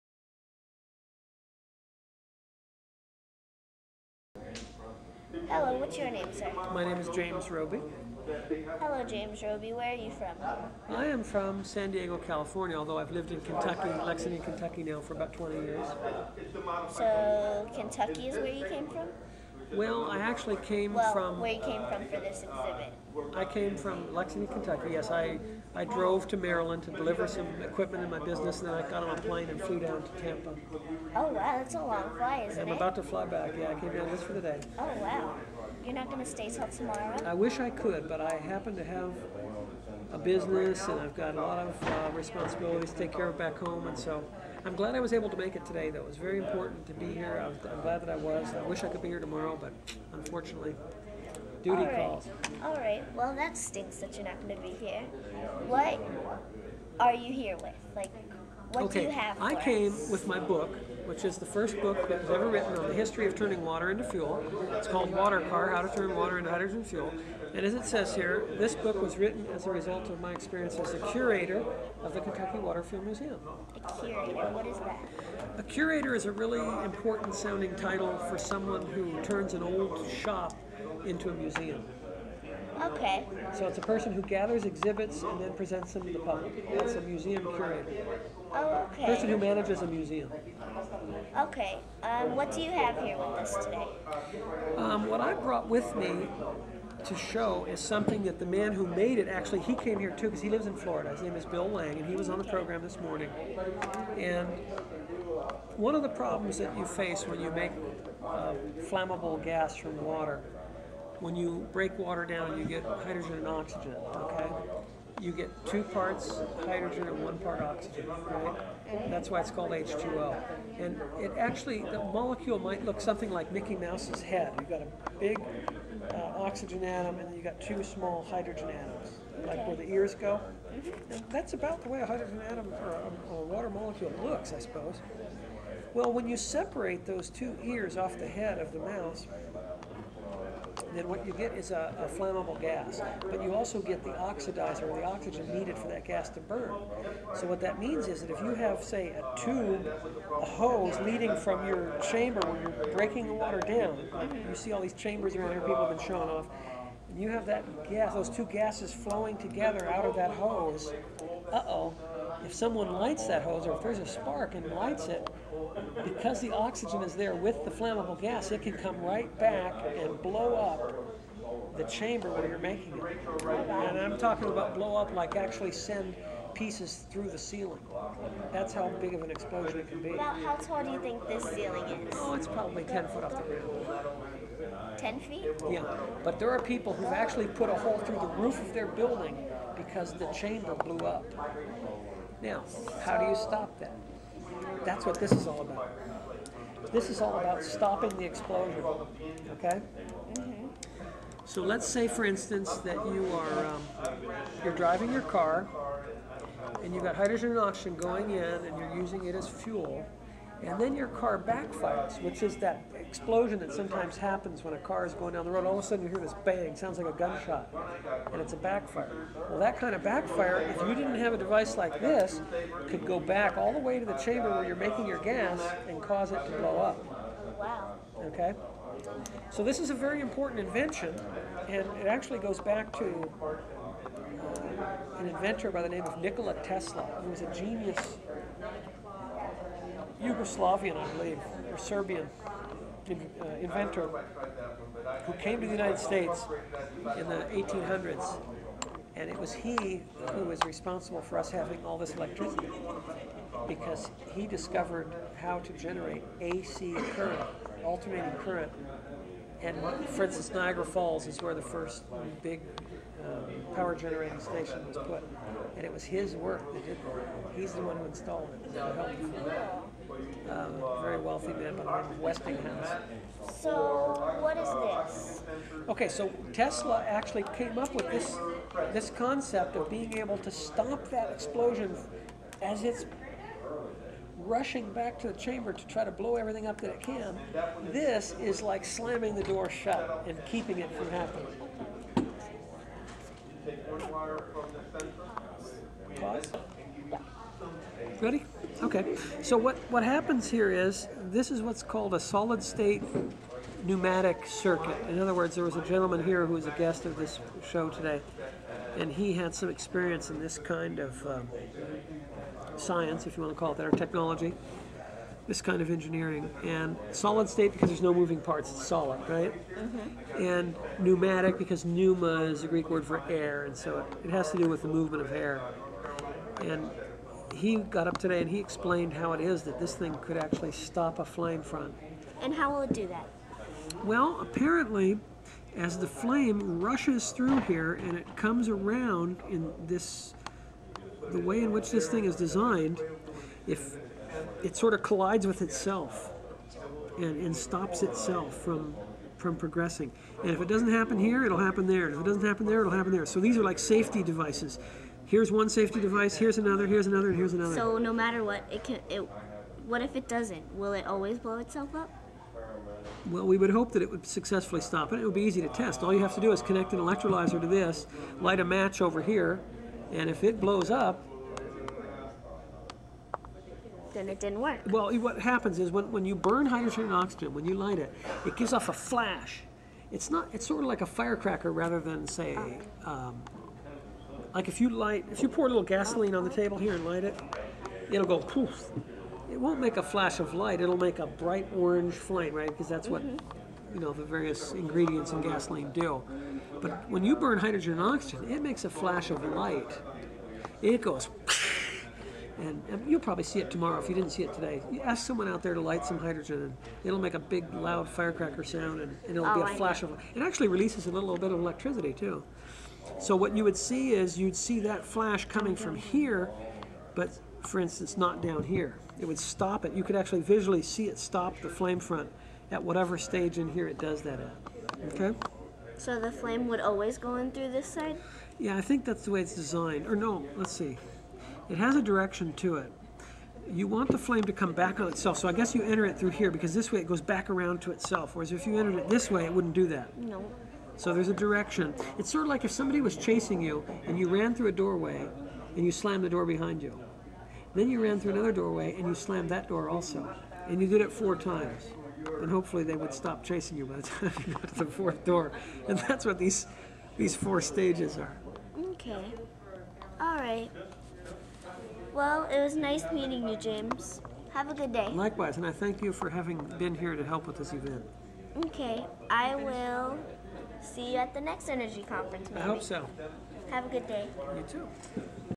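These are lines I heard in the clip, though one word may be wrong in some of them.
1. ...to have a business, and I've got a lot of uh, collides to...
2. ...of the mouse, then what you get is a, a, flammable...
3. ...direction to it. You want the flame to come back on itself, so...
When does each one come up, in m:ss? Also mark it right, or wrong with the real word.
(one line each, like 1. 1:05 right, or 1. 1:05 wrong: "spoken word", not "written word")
1. 0:38 wrong: "responsibilities", not "collides"
2. 2:18 right
3. 7:12 right.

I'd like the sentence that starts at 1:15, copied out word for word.
A curator is a really important sounding title for someone who turns an old shop into a museum.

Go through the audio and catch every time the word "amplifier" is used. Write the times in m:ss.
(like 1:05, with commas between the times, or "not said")
not said.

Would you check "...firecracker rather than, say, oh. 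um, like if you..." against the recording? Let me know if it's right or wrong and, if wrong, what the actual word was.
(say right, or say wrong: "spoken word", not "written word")
right.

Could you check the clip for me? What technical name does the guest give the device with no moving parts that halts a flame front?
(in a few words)
solid state pneumatic circuit.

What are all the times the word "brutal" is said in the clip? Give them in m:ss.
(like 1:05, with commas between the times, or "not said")
not said.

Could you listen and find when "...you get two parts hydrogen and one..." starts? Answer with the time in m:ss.
1:55.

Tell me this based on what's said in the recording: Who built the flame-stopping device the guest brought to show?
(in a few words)
Bill Lang.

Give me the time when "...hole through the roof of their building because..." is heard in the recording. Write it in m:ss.
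3:07.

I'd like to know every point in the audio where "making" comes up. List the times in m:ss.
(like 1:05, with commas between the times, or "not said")
2:52, 3:44.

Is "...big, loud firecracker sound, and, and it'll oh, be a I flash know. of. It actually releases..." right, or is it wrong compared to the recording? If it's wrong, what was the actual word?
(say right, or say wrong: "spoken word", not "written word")
right.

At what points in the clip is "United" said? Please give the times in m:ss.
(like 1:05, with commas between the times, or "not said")
4:05.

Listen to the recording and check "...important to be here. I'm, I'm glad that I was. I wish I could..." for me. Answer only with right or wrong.
right.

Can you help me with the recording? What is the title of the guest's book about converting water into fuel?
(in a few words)
Water Car.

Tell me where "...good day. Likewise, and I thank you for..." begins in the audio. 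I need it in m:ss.
7:44.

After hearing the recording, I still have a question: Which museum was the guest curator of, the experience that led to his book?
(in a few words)
Kentucky Water Fuel Museum.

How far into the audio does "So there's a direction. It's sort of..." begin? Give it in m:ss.
7:21.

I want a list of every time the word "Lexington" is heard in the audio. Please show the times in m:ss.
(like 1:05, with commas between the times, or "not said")
0:14, 0:24.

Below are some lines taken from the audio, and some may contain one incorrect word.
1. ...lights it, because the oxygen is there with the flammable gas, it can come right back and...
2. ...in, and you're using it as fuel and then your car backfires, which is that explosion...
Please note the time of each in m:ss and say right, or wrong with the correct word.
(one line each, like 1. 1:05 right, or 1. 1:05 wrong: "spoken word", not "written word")
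1. 2:44 right
2. 3:28 right.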